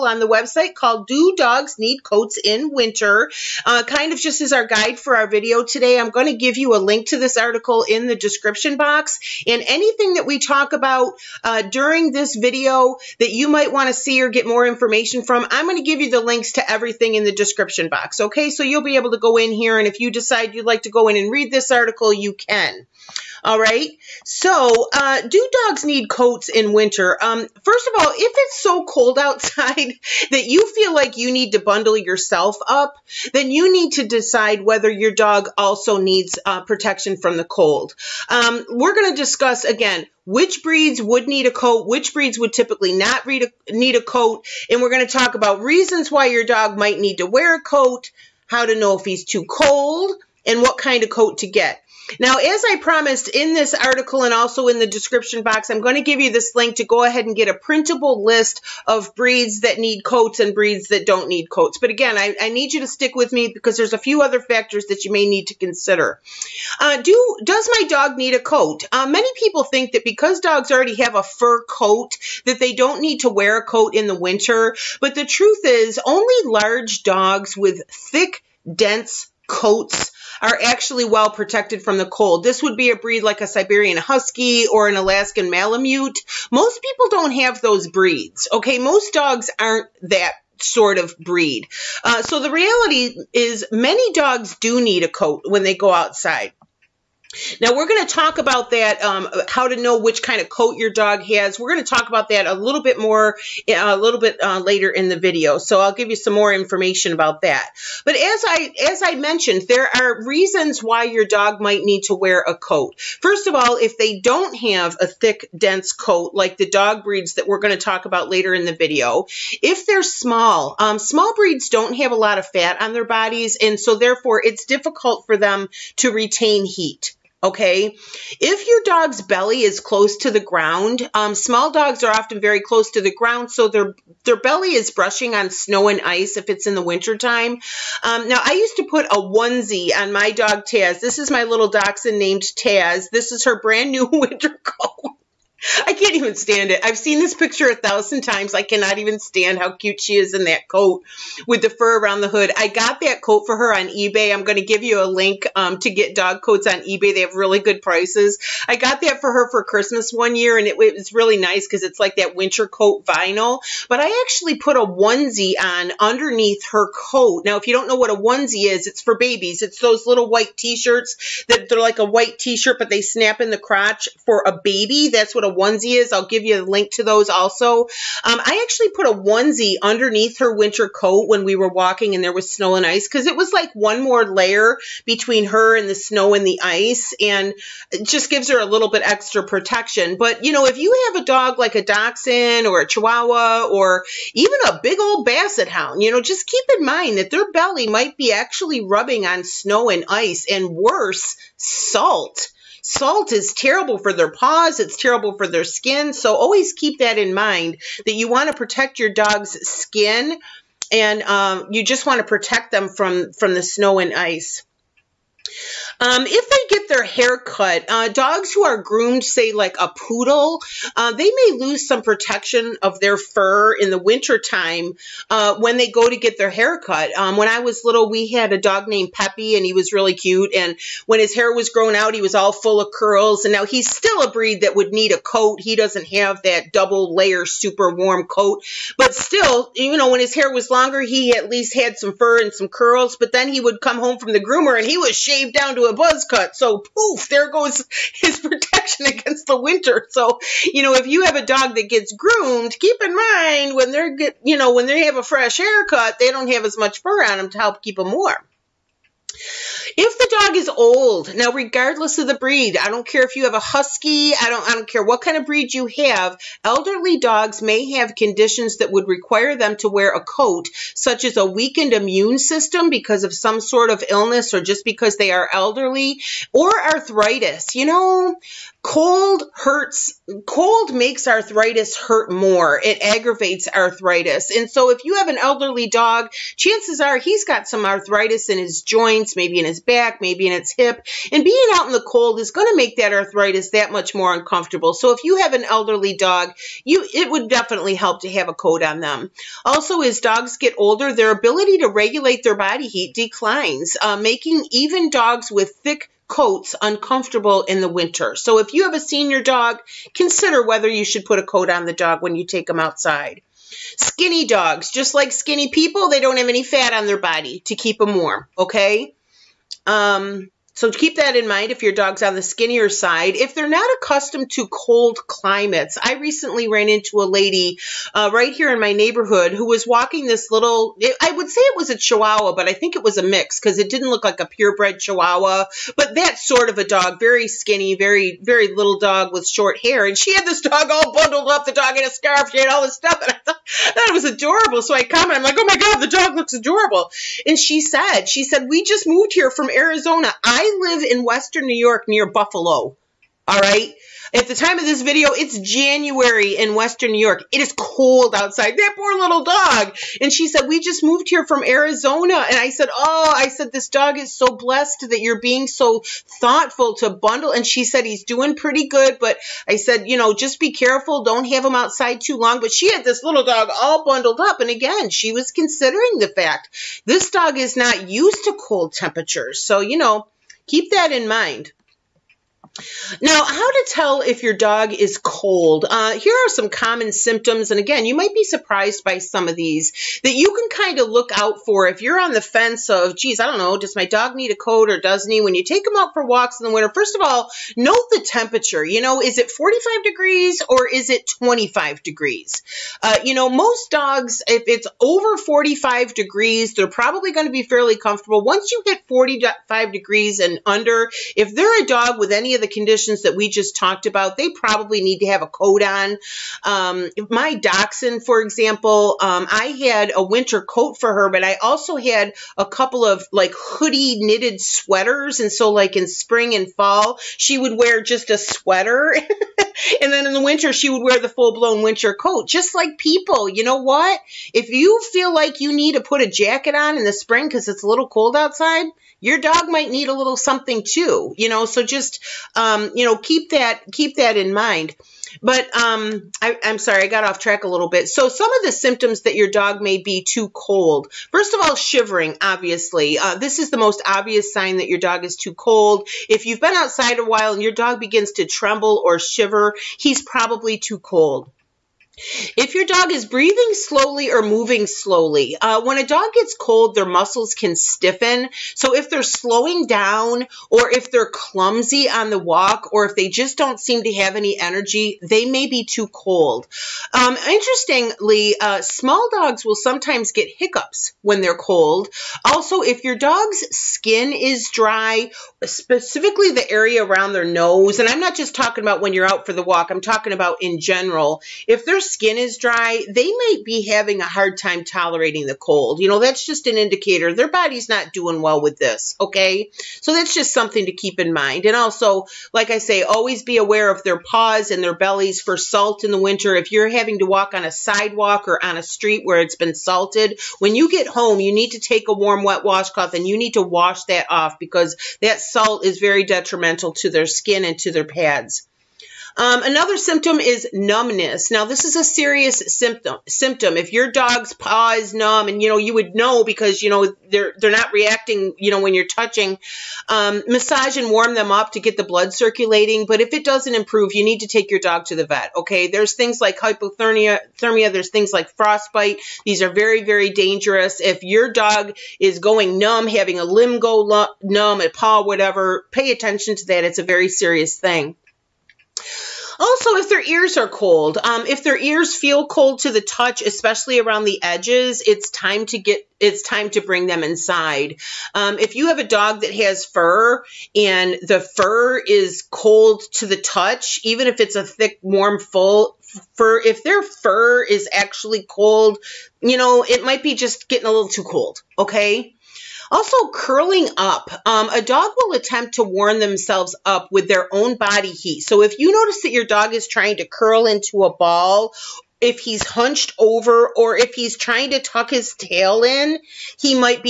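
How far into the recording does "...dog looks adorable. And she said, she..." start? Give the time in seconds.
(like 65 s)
346 s.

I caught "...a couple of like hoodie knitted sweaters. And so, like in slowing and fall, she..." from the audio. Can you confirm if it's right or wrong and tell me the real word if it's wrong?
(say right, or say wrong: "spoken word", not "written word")
wrong: "spring", not "slowing".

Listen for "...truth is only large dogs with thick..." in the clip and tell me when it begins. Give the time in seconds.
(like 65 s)
75 s.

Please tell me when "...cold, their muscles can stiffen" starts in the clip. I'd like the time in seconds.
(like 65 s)
466 s.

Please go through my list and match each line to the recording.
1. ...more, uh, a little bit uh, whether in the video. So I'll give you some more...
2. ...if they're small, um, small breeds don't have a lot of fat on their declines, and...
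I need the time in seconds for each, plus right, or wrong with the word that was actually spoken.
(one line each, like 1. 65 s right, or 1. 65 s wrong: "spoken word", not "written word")
1. 102 s wrong: "later", not "whether"
2. 119 s wrong: "bodies", not "declines".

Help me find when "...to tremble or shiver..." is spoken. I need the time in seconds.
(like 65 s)
458 s.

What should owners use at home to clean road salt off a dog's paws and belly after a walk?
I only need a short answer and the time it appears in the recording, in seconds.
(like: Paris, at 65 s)
A warm, wet washcloth, at 512 s.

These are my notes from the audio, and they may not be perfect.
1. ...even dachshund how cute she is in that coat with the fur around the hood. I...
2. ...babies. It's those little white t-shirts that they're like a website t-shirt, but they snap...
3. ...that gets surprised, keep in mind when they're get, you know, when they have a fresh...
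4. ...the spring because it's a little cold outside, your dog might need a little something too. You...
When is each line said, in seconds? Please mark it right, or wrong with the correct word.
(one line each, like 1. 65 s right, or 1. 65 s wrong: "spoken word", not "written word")
1. 148 s wrong: "stand", not "dachshund"
2. 169 s wrong: "white", not "website"
3. 251 s wrong: "groomed", not "surprised"
4. 437 s right.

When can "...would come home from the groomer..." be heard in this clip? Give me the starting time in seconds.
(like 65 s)
243 s.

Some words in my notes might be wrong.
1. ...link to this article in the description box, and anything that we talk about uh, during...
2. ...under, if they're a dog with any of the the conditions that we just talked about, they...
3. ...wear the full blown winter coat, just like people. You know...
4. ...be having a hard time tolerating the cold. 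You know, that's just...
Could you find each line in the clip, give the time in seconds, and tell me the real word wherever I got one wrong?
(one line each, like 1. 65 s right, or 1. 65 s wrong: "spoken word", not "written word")
1. 6 s right
2. 410 s right
3. 431 s right
4. 493 s right.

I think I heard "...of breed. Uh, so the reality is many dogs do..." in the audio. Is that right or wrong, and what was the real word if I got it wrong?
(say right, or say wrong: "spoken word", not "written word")
right.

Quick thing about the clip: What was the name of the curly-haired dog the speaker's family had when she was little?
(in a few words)
Peppy.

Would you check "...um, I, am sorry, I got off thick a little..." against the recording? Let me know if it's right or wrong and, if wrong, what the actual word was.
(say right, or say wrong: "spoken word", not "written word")
wrong: "track", not "thick".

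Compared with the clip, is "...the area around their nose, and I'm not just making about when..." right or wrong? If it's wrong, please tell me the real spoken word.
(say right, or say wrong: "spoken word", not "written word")
wrong: "talking", not "making".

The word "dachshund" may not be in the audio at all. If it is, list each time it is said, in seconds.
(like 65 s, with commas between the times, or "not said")
141 s, 191 s, 417 s.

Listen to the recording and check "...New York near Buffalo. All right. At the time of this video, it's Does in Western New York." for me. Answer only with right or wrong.
wrong.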